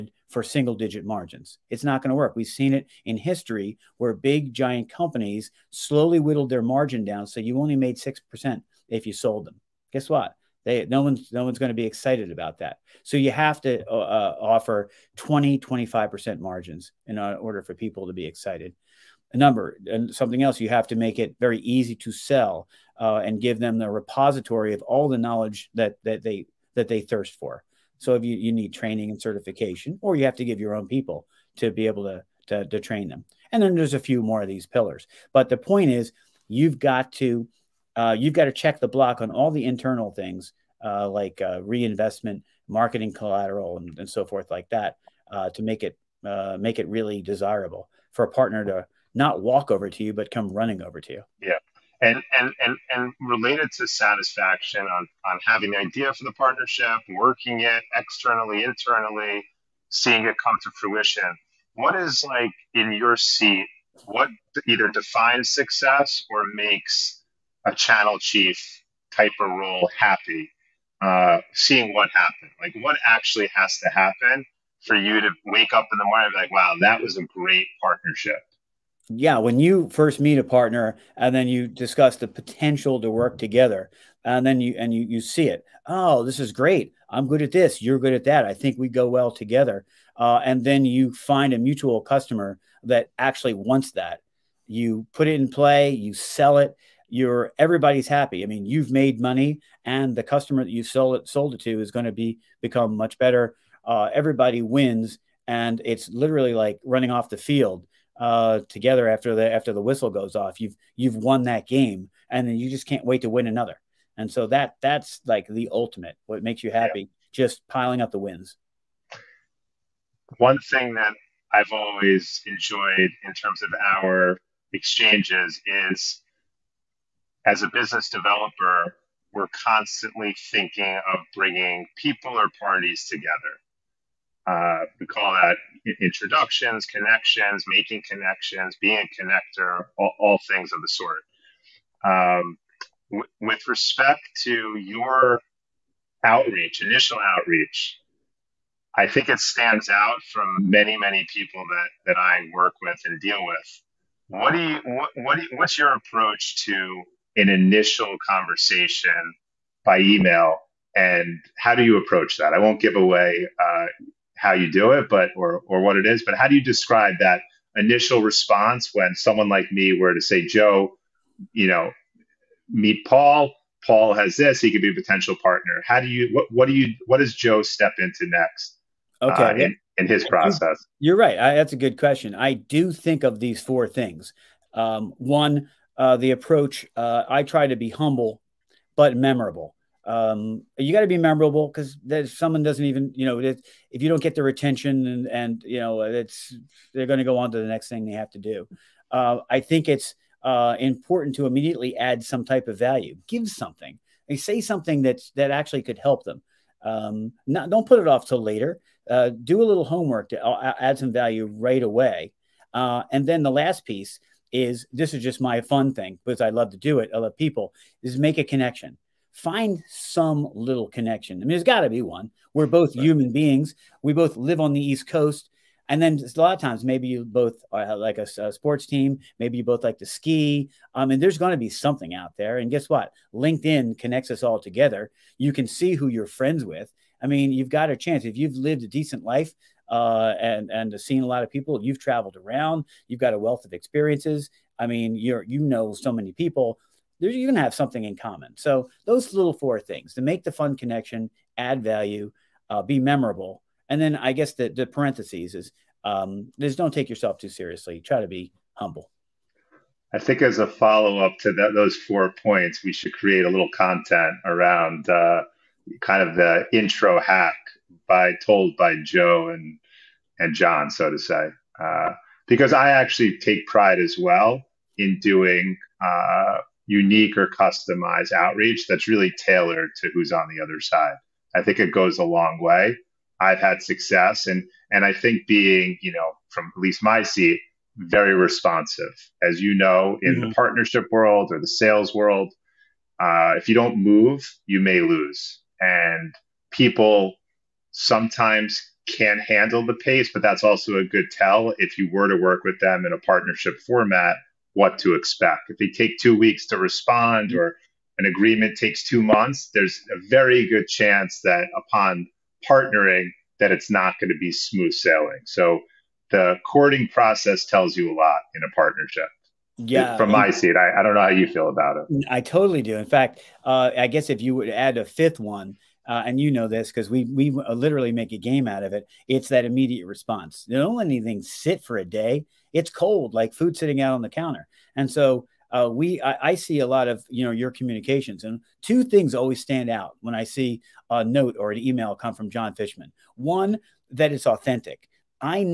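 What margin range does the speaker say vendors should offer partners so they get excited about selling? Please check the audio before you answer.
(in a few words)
20-25%.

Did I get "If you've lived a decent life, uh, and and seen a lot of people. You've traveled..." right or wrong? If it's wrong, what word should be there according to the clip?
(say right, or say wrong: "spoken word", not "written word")
right.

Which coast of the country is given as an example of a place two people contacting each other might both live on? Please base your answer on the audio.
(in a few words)
East Coast.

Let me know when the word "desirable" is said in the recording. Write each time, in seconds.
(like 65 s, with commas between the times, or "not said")
47 s.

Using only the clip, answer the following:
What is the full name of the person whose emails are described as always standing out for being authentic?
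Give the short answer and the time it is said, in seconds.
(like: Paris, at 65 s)
John Fishman, at 342 s.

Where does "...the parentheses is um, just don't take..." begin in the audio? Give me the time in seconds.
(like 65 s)
254 s.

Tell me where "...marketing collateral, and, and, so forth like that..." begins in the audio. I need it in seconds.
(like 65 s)
42 s.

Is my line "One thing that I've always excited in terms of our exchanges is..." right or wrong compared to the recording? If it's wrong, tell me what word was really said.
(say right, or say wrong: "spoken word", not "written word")
wrong: "enjoyed", not "excited".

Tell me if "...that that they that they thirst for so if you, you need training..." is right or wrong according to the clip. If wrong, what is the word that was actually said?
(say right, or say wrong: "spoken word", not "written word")
right.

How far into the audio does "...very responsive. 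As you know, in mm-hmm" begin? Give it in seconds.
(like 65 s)
287 s.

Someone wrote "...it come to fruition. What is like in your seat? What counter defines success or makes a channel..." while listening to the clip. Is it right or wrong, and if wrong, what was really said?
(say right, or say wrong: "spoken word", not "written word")
wrong: "either", not "counter".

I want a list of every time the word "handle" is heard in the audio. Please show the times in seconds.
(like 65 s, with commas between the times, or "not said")
299 s.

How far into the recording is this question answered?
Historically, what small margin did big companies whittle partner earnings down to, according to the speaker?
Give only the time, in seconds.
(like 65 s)
7 s.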